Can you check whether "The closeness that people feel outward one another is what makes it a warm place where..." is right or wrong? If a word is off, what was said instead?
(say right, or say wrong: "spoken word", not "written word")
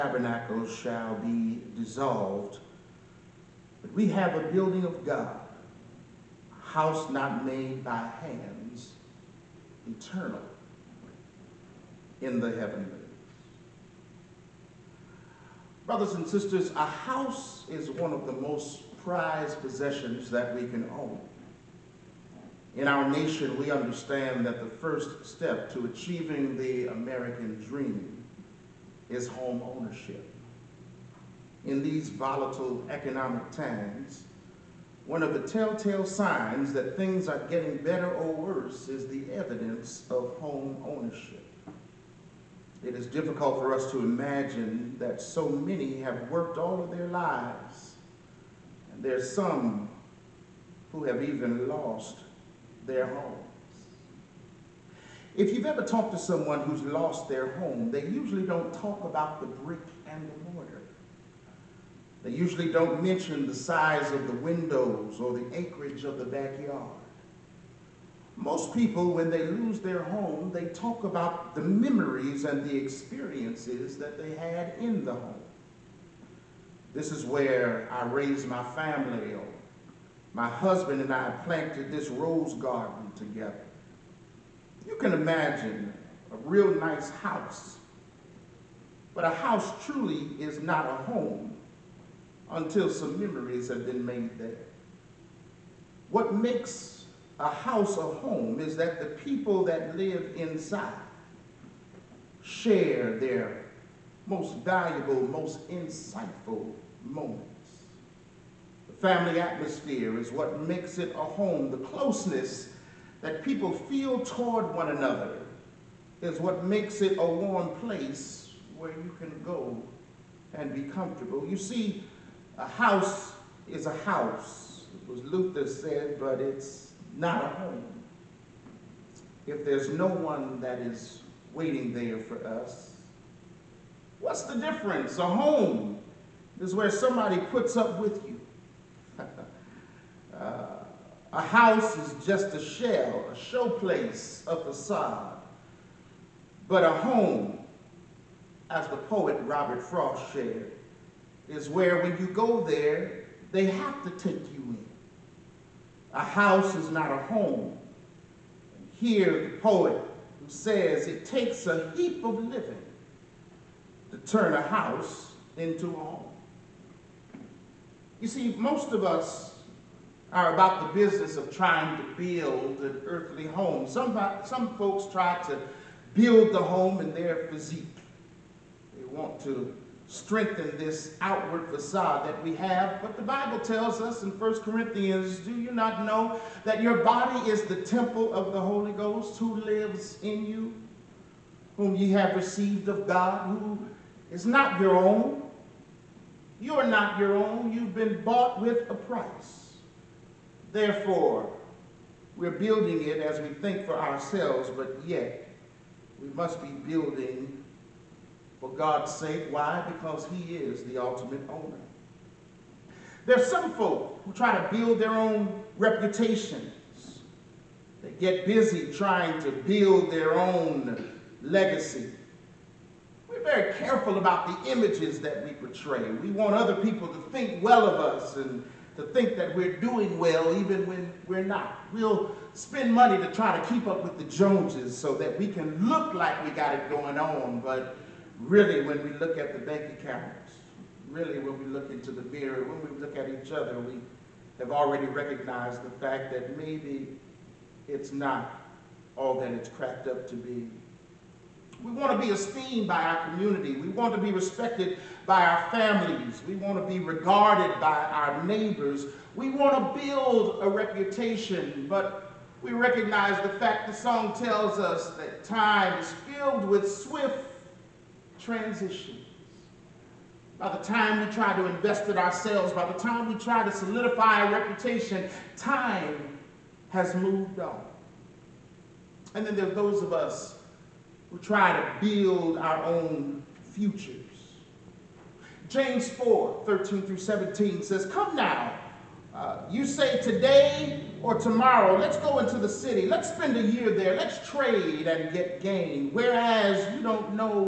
wrong: "toward", not "outward".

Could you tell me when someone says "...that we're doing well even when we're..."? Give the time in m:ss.
3:49.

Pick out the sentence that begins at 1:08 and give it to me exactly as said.
Most people, when they lose their home, they talk about the memories and the experiences that they had in the home.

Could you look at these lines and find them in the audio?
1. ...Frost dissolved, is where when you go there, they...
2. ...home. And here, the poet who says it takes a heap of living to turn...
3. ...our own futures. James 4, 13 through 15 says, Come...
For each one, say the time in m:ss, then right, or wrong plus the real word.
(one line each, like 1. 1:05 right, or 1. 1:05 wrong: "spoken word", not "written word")
1. 2:29 wrong: "shared", not "dissolved"
2. 2:37 right
3. 4:42 wrong: "17", not "15".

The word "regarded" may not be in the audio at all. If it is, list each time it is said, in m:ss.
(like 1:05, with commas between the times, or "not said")
4:16.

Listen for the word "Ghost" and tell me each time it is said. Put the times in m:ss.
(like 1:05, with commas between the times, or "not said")
3:08.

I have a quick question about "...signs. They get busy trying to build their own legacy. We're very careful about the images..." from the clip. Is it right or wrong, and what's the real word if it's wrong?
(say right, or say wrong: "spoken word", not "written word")
wrong: "reputations", not "signs".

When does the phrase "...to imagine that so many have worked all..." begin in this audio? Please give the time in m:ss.
0:43.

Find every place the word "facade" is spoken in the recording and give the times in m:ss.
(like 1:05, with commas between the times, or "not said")
2:24, 3:01.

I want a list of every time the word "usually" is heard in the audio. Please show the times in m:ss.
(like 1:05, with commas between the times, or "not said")
0:58, 1:02.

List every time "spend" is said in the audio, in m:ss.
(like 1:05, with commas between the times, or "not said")
3:52, 4:53.